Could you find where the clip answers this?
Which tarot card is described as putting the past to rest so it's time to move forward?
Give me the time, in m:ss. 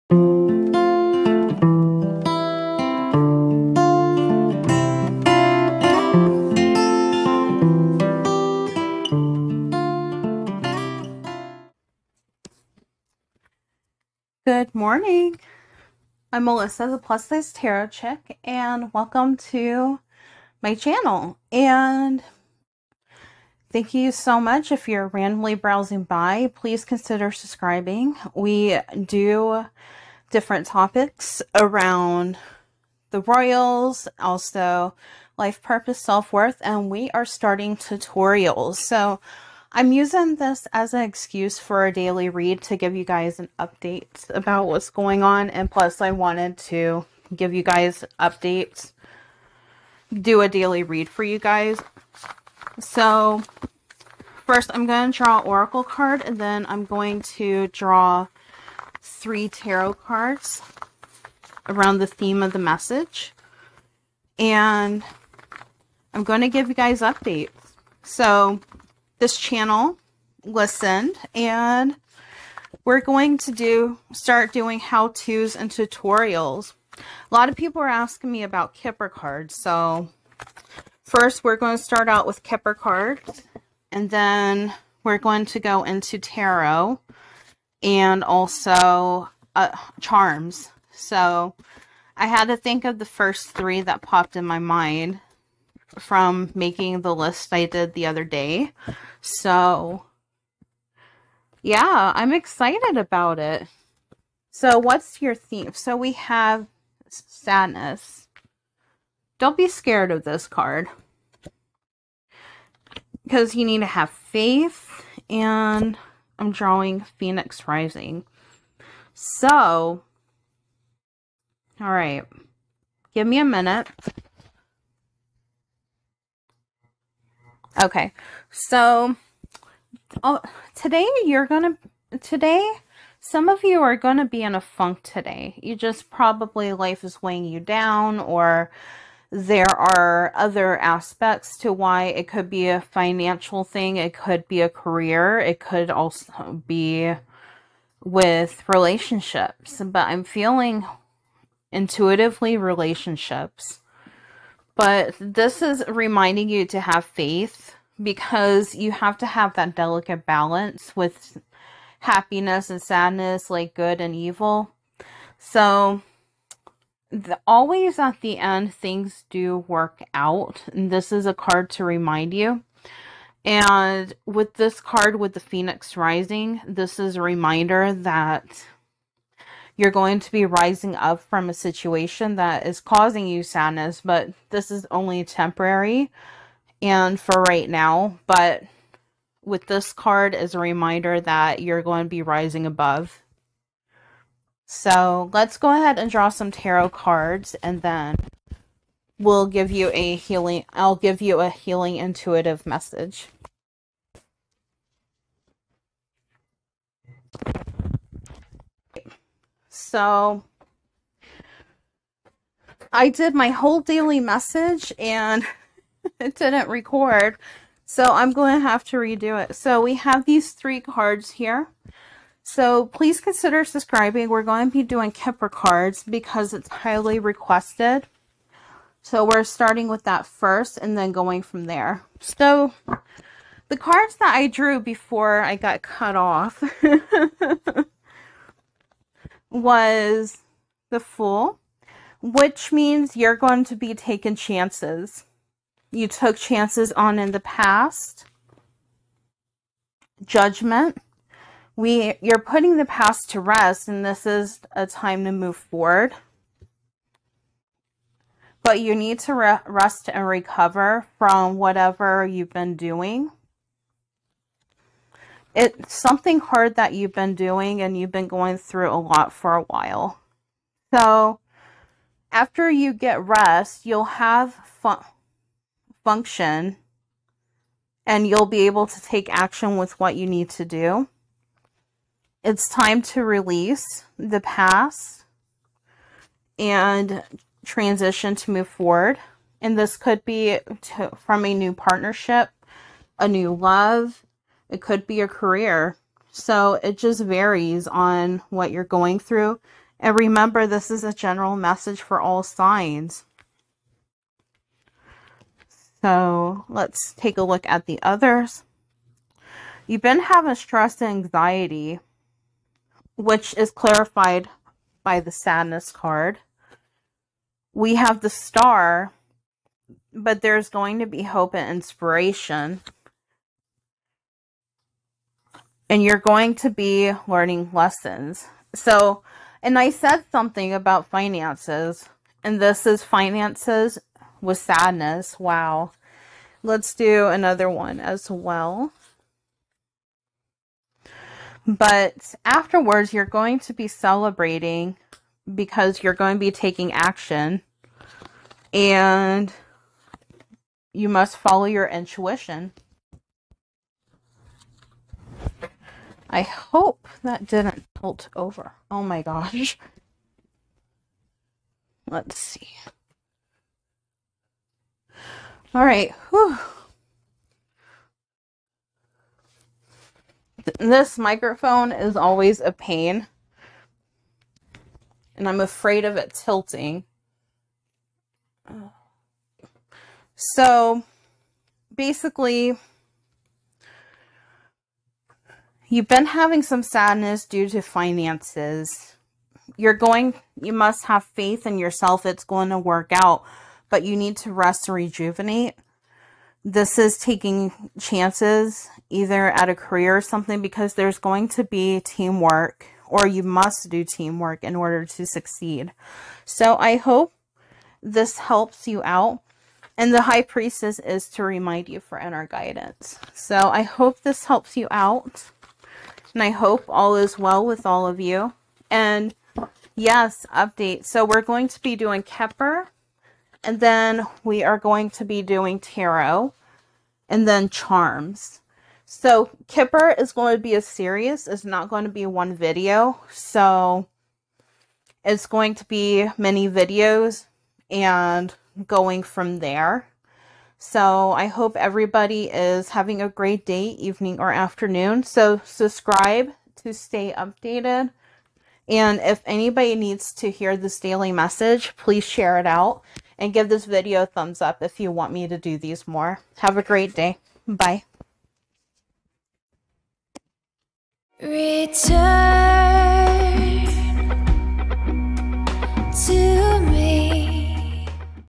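4:10.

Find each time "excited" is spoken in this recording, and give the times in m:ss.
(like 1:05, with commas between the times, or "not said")
1:42.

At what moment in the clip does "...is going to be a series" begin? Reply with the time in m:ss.
7:10.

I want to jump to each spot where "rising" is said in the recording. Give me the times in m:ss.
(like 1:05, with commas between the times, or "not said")
1:57, 2:55, 3:00, 3:12.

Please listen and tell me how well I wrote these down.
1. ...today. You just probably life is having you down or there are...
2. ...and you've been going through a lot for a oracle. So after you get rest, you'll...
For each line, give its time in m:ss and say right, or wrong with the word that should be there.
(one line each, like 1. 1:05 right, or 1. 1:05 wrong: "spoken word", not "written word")
1. 2:15 wrong: "weighing", not "having"
2. 4:27 wrong: "while", not "oracle".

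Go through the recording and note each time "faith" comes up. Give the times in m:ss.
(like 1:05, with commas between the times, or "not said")
1:54, 2:37, 6:31.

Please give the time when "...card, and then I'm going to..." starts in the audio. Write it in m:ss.
0:55.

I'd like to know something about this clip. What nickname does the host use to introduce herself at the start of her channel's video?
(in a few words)
Plus Size Tarot Chick.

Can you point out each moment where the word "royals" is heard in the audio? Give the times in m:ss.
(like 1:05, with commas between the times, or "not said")
0:33.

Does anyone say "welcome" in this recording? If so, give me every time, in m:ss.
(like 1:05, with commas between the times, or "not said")
0:18.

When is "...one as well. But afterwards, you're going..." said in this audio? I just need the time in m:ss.
5:37.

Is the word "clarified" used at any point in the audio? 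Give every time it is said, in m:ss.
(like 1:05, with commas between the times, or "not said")
5:13.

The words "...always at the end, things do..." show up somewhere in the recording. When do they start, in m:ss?
2:47.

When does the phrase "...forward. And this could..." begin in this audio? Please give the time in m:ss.
4:48.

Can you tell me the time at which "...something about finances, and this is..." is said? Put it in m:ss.
5:30.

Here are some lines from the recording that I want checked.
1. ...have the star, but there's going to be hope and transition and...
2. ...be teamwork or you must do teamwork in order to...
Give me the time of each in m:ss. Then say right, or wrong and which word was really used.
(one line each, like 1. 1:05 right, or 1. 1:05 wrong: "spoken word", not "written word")
1. 5:17 wrong: "inspiration", not "transition"
2. 6:41 right.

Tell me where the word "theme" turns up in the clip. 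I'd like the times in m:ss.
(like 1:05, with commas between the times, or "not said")
1:02, 1:45.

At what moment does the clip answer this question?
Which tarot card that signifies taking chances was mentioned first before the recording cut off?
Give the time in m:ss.
4:00.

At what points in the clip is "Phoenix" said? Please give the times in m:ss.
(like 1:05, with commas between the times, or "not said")
1:57, 2:55.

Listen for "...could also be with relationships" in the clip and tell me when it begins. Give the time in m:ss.
2:25.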